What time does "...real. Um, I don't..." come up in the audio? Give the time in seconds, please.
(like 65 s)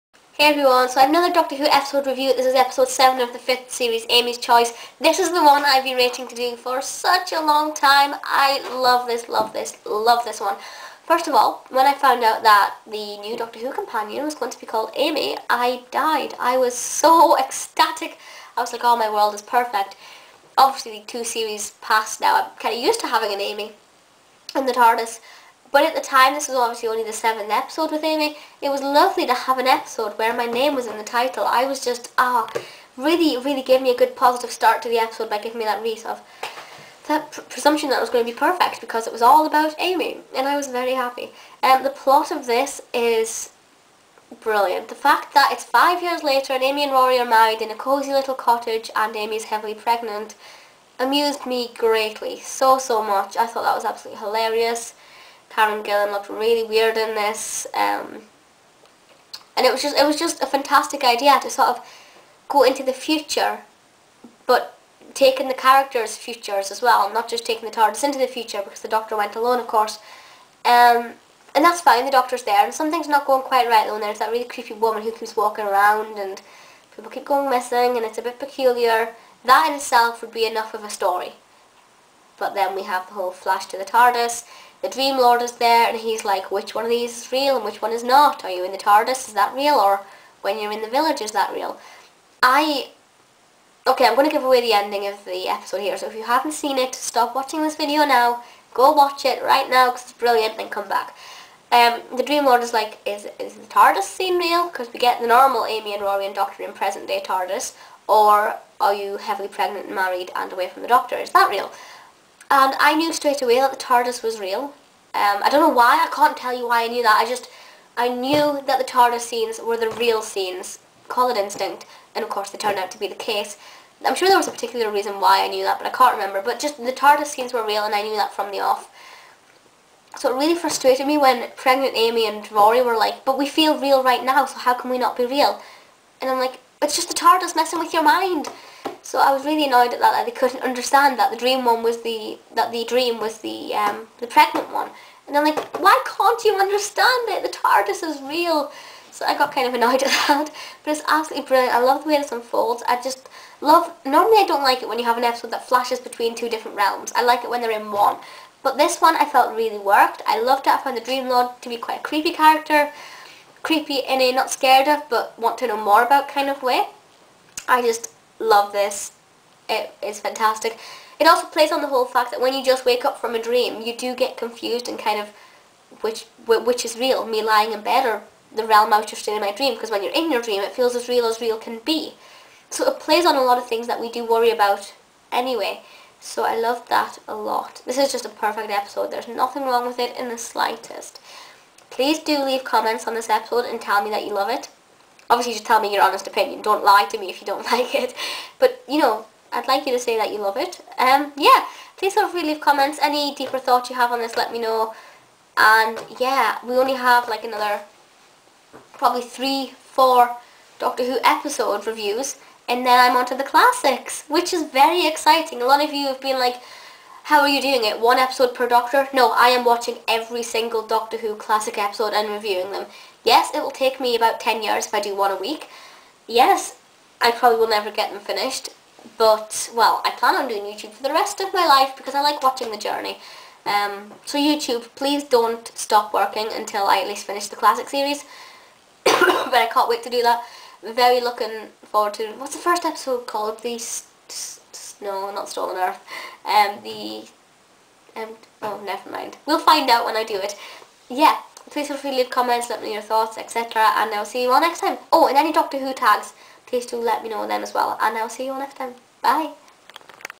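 114 s.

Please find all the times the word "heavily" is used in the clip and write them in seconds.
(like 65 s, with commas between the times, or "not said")
49 s, 109 s.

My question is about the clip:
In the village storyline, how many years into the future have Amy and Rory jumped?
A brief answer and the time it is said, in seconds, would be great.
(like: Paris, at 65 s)
5 years, at 45 s.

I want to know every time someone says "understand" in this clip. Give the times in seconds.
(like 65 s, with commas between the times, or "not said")
140 s, 146 s.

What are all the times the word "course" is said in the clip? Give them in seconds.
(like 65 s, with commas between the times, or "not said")
69 s, 122 s.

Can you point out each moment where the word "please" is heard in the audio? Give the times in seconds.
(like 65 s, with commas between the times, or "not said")
191 s, 201 s, 234 s, 251 s, 256 s.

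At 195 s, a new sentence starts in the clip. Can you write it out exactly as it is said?
Obviously, just tell me your honest opinion.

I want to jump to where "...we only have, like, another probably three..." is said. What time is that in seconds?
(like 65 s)
206 s.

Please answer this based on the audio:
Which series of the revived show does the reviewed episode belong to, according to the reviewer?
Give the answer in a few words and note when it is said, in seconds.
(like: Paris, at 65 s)
5th series, at 3 s.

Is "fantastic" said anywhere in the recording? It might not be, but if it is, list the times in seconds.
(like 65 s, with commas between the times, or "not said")
60 s, 170 s.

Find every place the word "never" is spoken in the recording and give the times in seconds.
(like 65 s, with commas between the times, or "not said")
227 s, 248 s.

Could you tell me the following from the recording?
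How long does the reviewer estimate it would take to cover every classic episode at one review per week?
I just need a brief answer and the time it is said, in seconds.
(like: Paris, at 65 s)
10 years, at 224 s.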